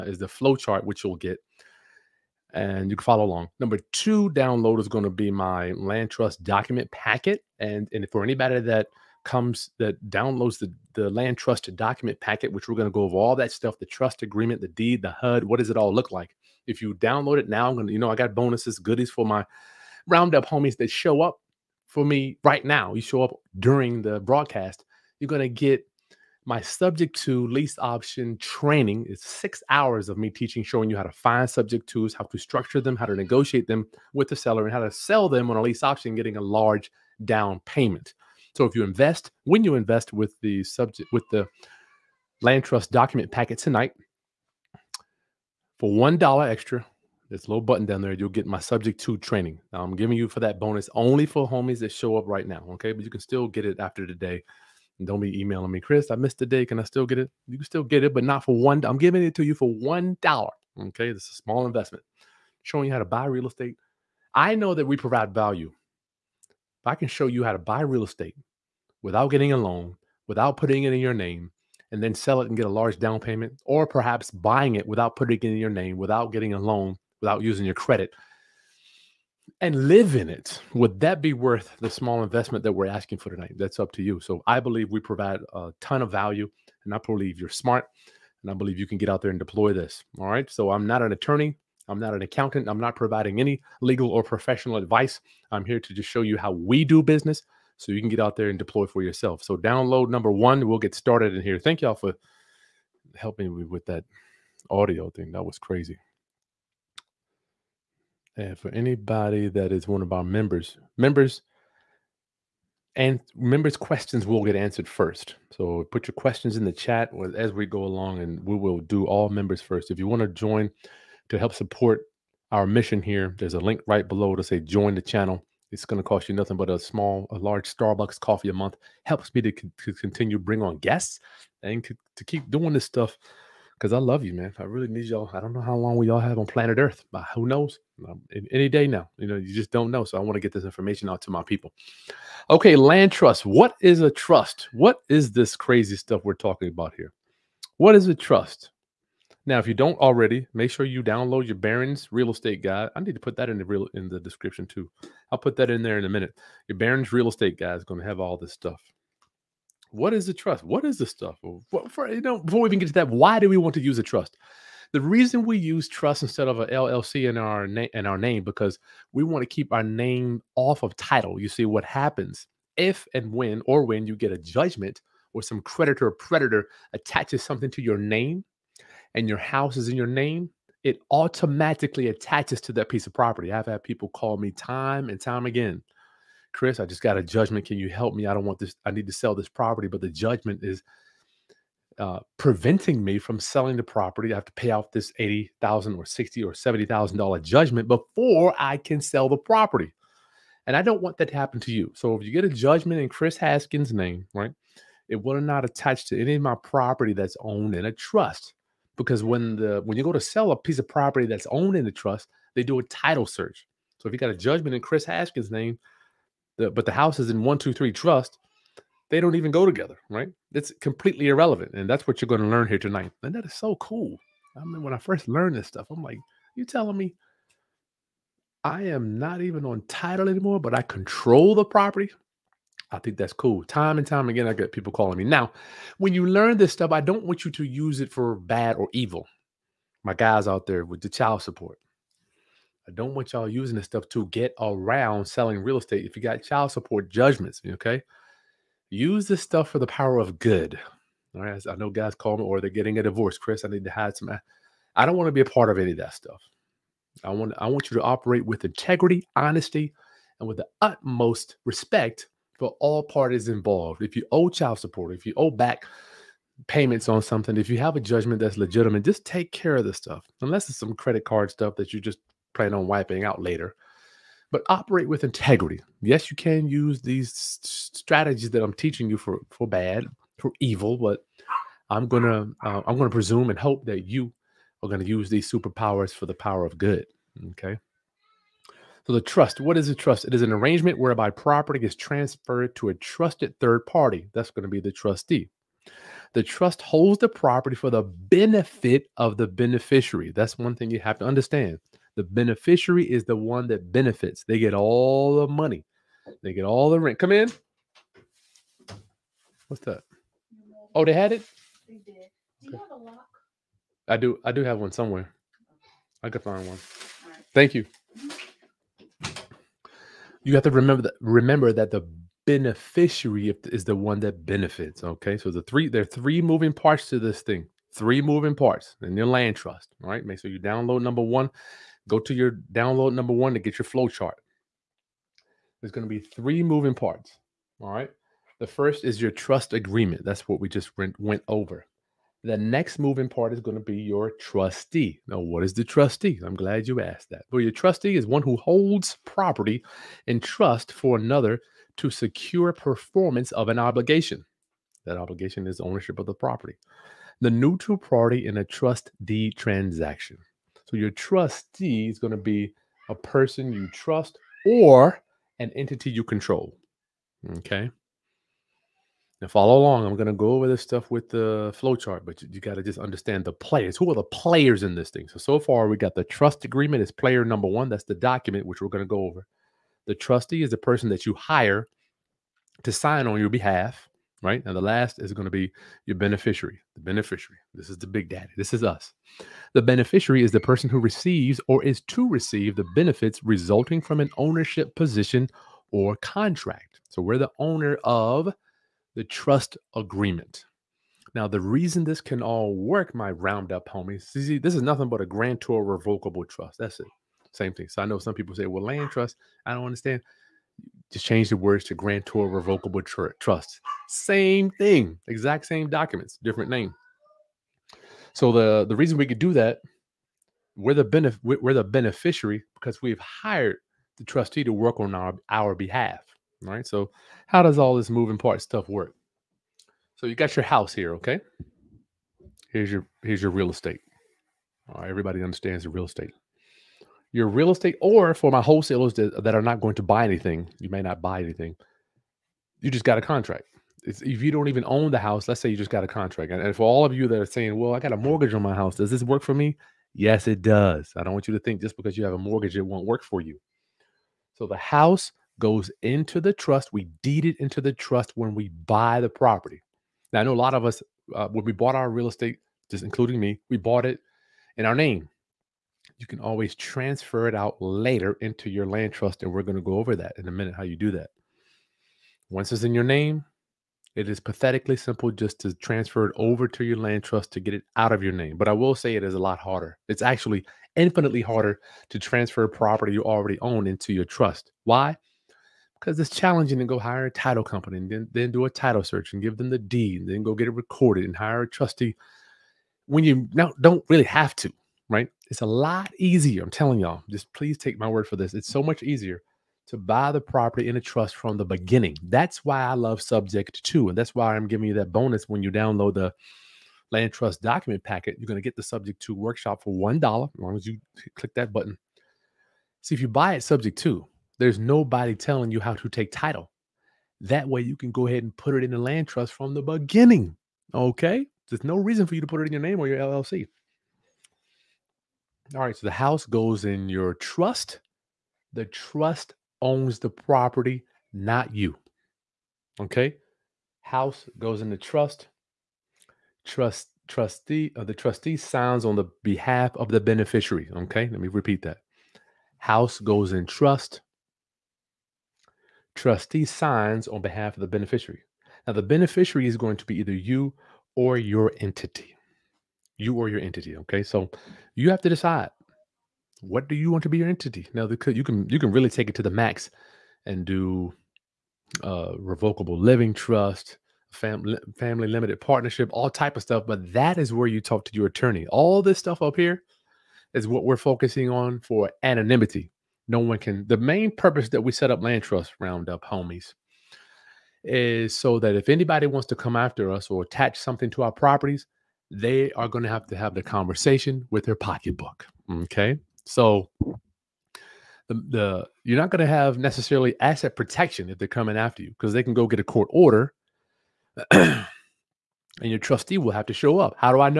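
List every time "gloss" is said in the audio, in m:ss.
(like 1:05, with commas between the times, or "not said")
not said.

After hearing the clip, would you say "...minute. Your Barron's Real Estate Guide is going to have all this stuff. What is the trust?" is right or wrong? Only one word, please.
right.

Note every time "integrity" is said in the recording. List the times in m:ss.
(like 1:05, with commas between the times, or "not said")
4:18, 4:35.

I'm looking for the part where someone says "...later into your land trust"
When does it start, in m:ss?
7:47.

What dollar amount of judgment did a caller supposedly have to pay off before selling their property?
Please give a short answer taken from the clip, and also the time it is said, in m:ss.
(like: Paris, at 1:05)
$80,000, at 3:15.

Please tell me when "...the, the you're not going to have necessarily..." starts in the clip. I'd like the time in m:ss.
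9:46.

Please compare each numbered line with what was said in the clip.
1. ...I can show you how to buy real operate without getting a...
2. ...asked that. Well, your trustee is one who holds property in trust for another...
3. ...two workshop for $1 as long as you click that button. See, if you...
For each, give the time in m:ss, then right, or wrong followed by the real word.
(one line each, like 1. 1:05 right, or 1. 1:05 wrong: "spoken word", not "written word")
1. 1:06 wrong: "estate", not "operate"
2. 5:47 right
3. 8:29 right.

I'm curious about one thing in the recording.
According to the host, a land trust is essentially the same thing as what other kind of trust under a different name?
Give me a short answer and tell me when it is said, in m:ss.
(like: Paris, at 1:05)
Grantor revocable trust, at 6:45.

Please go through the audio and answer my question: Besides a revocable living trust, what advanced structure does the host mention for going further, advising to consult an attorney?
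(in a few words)
Family limited partnership.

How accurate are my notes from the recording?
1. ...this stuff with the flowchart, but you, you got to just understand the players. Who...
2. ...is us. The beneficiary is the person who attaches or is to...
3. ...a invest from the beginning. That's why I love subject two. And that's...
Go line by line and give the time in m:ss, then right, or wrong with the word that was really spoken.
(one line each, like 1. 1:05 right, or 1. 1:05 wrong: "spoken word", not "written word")
1. 6:10 right
2. 6:28 wrong: "receives", not "attaches"
3. 8:20 wrong: "trust", not "invest".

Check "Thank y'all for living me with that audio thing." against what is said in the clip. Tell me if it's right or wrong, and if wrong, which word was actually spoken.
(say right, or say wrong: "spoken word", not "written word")
wrong: "helping", not "living".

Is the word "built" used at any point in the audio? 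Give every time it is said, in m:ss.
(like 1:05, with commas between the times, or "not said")
not said.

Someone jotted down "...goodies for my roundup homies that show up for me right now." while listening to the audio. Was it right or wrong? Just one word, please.
right.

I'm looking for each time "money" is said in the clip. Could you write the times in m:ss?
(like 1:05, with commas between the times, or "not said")
5:05.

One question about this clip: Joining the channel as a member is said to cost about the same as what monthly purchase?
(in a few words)
A large Starbucks coffee.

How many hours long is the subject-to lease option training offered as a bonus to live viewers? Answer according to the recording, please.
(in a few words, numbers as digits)
6.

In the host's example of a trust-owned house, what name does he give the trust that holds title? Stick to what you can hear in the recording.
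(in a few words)
One, two, three trust.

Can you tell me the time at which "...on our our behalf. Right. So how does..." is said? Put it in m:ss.
7:04.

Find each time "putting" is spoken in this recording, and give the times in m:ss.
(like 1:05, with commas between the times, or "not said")
1:10, 1:15.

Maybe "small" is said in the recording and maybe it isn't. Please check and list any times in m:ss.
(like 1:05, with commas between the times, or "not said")
1:01, 1:21, 2:06.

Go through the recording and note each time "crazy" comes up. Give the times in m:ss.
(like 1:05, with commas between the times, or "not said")
1:45, 2:25.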